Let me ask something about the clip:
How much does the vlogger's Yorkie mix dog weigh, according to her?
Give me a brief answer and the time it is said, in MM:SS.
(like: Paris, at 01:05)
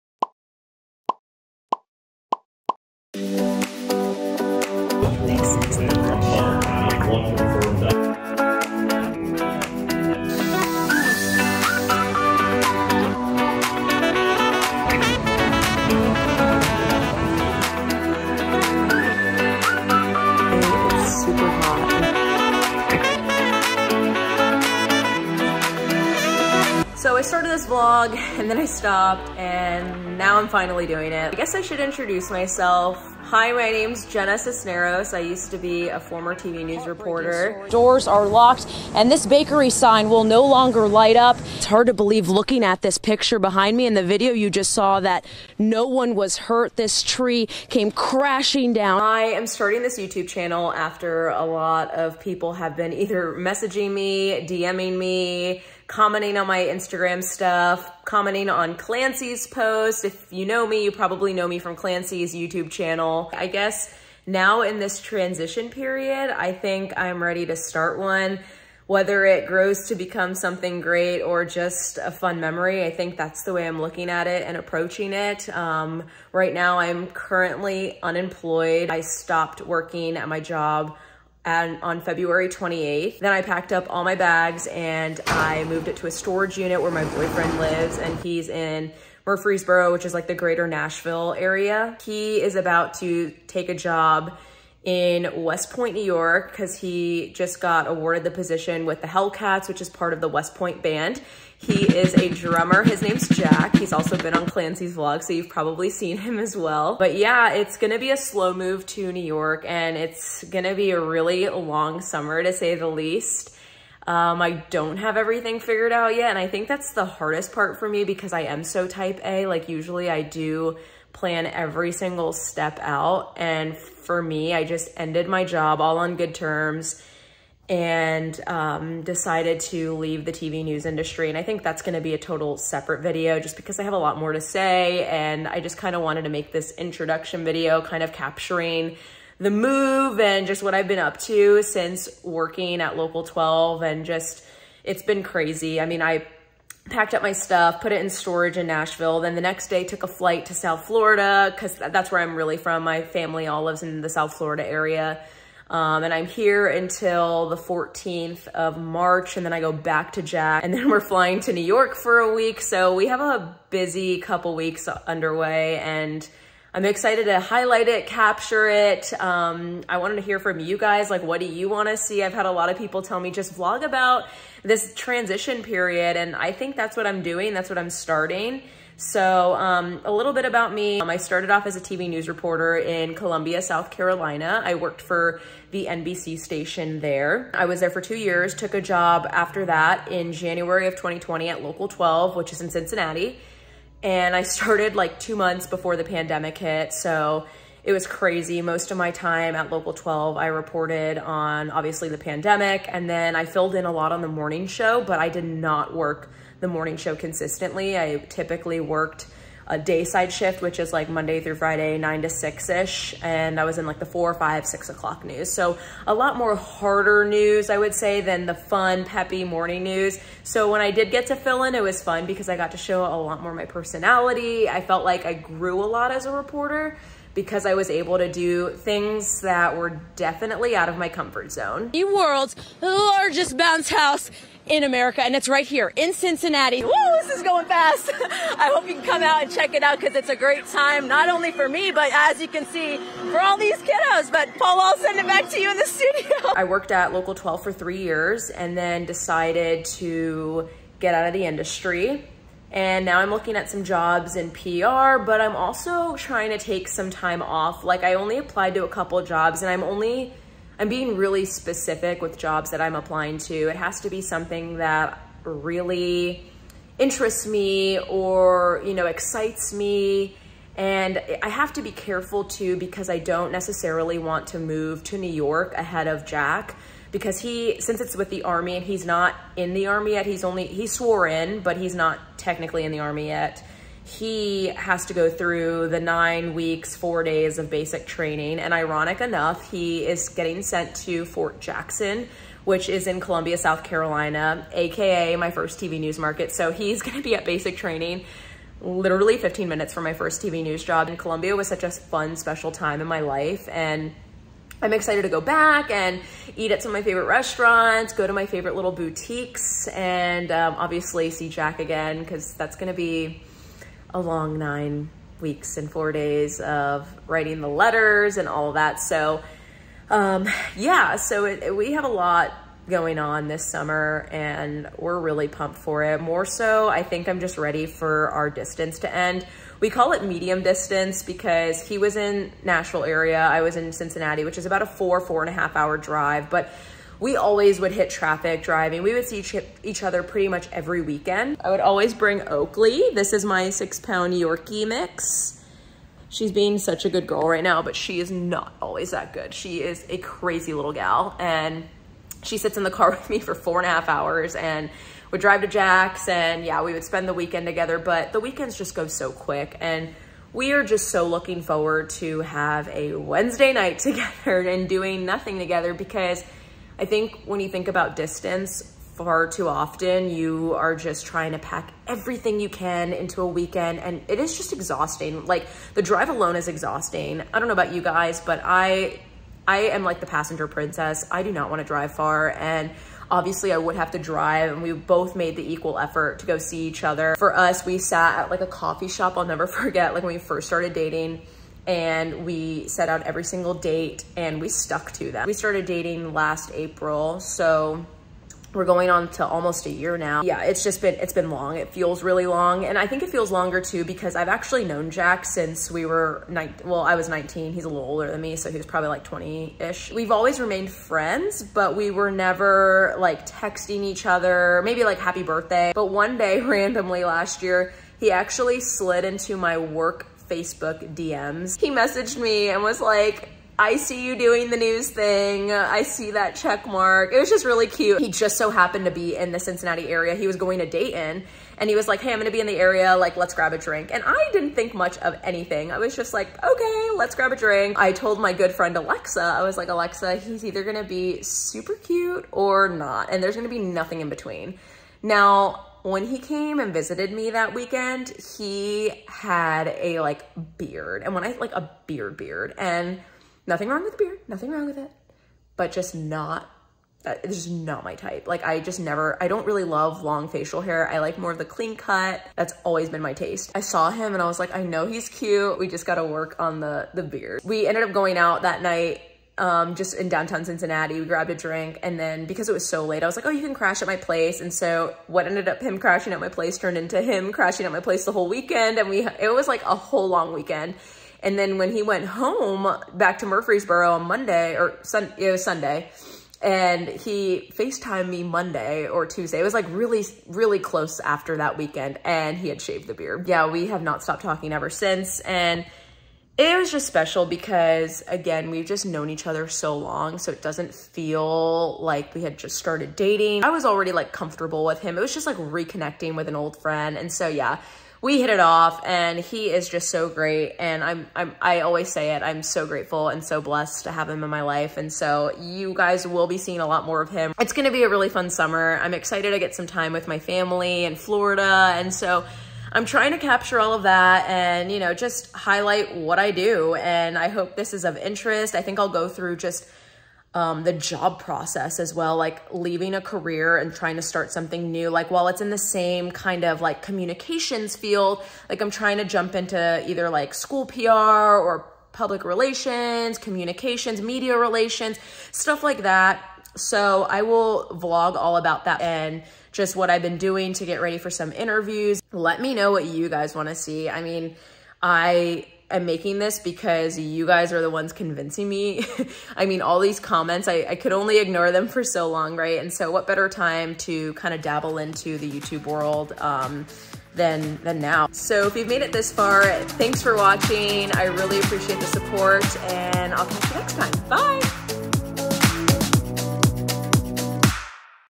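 6 pounds, at 05:43.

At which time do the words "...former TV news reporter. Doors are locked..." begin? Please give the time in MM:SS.
00:35.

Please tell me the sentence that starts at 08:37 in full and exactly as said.
It's going to be a really fun summer.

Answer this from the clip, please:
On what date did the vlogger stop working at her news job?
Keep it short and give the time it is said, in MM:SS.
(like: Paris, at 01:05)
February 28, at 01:22.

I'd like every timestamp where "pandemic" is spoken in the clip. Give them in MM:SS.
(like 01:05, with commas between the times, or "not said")
03:16, 03:22.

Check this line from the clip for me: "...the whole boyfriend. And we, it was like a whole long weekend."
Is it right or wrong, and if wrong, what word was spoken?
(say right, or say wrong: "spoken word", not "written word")
wrong: "weekend", not "boyfriend".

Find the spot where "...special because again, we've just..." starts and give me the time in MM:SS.
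08:17.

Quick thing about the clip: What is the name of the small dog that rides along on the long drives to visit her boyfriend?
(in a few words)
Oakley.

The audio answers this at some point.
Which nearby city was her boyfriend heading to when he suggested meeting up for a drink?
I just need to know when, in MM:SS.
07:10.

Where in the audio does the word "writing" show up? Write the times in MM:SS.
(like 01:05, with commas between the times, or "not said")
05:17.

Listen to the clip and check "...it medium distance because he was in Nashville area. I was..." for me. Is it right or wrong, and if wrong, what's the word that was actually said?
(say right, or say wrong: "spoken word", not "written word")
right.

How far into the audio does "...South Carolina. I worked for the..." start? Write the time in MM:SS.
03:03.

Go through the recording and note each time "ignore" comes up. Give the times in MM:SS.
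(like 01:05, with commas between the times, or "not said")
09:21.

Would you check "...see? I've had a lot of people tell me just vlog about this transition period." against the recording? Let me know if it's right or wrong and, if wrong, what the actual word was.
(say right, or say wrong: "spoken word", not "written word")
right.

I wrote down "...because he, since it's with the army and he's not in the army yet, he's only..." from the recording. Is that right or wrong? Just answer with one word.
right.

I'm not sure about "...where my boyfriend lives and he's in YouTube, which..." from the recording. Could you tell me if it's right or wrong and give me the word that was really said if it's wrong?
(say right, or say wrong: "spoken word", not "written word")
wrong: "Murfreesboro", not "YouTube".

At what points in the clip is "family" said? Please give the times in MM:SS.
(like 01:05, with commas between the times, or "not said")
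02:33, 08:40.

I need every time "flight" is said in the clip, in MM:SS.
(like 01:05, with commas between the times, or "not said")
02:30.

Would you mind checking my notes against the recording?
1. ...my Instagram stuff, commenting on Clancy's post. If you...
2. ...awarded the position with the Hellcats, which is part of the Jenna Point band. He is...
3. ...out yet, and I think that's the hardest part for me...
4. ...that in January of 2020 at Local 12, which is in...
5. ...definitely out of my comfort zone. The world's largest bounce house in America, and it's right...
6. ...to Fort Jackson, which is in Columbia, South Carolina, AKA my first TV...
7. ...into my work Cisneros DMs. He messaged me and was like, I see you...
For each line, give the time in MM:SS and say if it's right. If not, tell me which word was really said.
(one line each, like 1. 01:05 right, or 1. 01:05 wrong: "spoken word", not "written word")
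1. 00:56 right
2. 01:37 wrong: "West", not "Jenna"
3. 01:55 right
4. 03:09 right
5. 03:50 right
6. 04:50 right
7. 06:59 wrong: "Facebook", not "Cisneros".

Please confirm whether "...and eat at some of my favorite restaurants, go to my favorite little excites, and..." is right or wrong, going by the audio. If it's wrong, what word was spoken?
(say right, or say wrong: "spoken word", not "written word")
wrong: "boutiques", not "excites".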